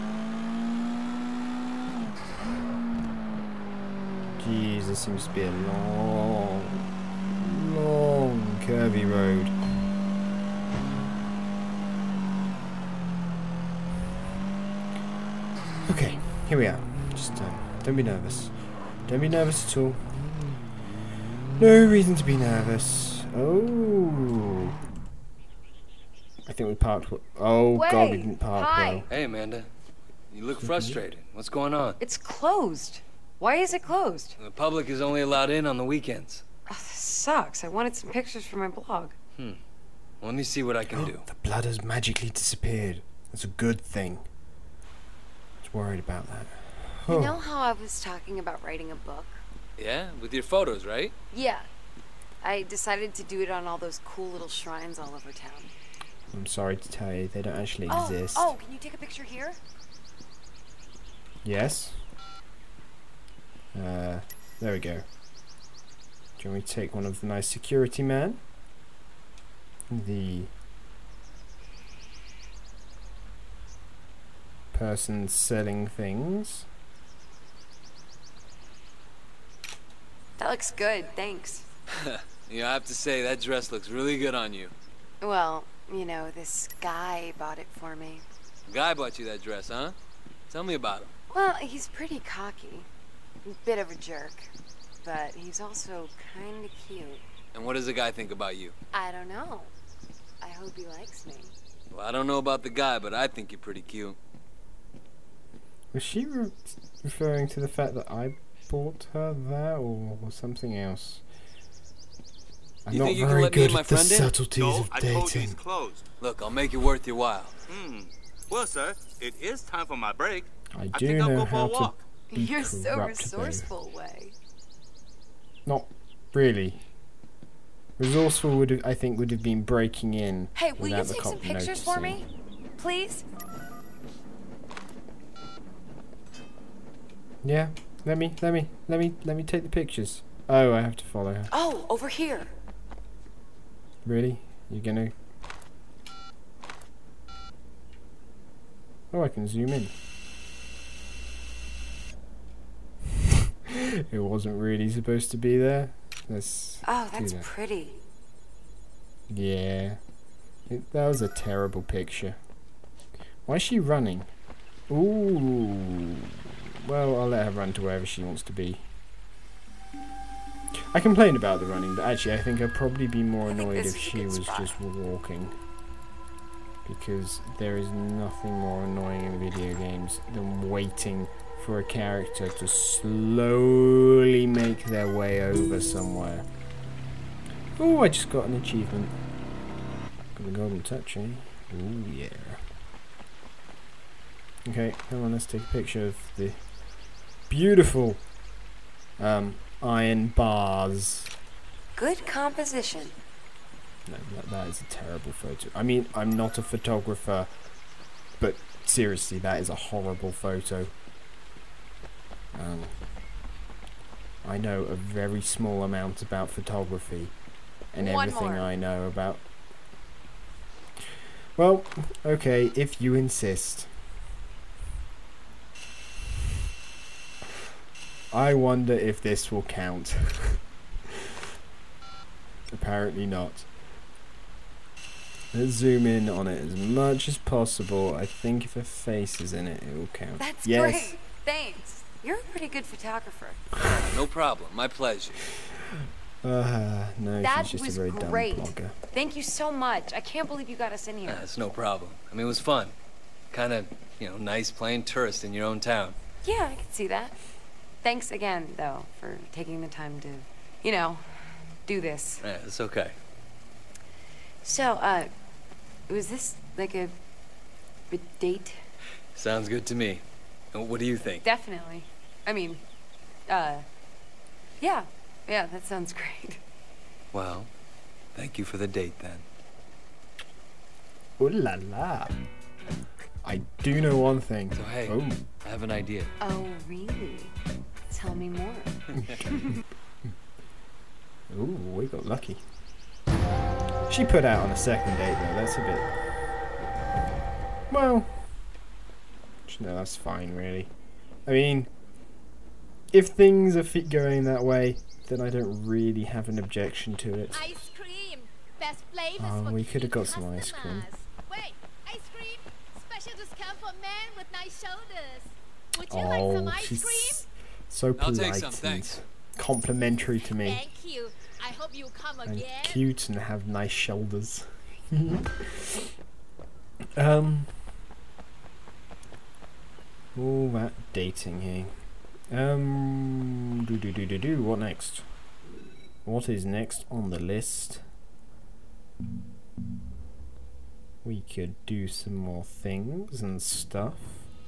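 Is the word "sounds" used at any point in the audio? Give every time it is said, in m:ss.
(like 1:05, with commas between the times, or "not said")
4:29, 4:35.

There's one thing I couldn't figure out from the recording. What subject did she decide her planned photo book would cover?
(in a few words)
Shrines.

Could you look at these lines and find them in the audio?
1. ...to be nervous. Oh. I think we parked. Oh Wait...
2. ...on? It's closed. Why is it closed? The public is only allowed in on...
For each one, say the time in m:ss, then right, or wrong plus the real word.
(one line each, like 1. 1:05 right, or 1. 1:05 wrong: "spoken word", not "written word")
1. 0:22 right
2. 0:31 right.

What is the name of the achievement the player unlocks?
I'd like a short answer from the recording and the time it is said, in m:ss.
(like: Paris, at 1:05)
Golden touch, at 3:10.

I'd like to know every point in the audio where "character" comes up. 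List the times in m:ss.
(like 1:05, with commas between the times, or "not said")
3:01.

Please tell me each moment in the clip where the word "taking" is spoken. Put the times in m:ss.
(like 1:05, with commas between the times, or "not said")
4:19.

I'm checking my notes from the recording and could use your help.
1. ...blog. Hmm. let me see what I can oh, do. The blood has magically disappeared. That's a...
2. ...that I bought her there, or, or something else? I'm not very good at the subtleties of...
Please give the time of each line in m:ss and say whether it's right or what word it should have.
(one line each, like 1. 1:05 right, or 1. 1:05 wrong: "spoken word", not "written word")
1. 0:38 right
2. 1:47 right.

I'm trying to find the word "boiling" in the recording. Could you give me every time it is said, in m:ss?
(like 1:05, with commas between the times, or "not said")
not said.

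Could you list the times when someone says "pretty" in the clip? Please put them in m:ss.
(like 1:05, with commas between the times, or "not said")
1:31, 1:43, 2:37, 4:02.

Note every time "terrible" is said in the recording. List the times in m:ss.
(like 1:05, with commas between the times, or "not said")
2:41, 3:24.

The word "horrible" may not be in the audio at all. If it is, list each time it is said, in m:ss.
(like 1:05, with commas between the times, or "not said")
3:29.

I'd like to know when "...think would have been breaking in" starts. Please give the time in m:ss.
2:08.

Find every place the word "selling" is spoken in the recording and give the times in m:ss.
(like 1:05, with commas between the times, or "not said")
1:15.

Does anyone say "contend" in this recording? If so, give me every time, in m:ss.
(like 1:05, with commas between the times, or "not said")
not said.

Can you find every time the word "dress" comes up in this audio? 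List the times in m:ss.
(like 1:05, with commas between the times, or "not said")
1:23, 1:29.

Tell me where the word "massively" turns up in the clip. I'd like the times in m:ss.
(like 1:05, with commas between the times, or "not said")
not said.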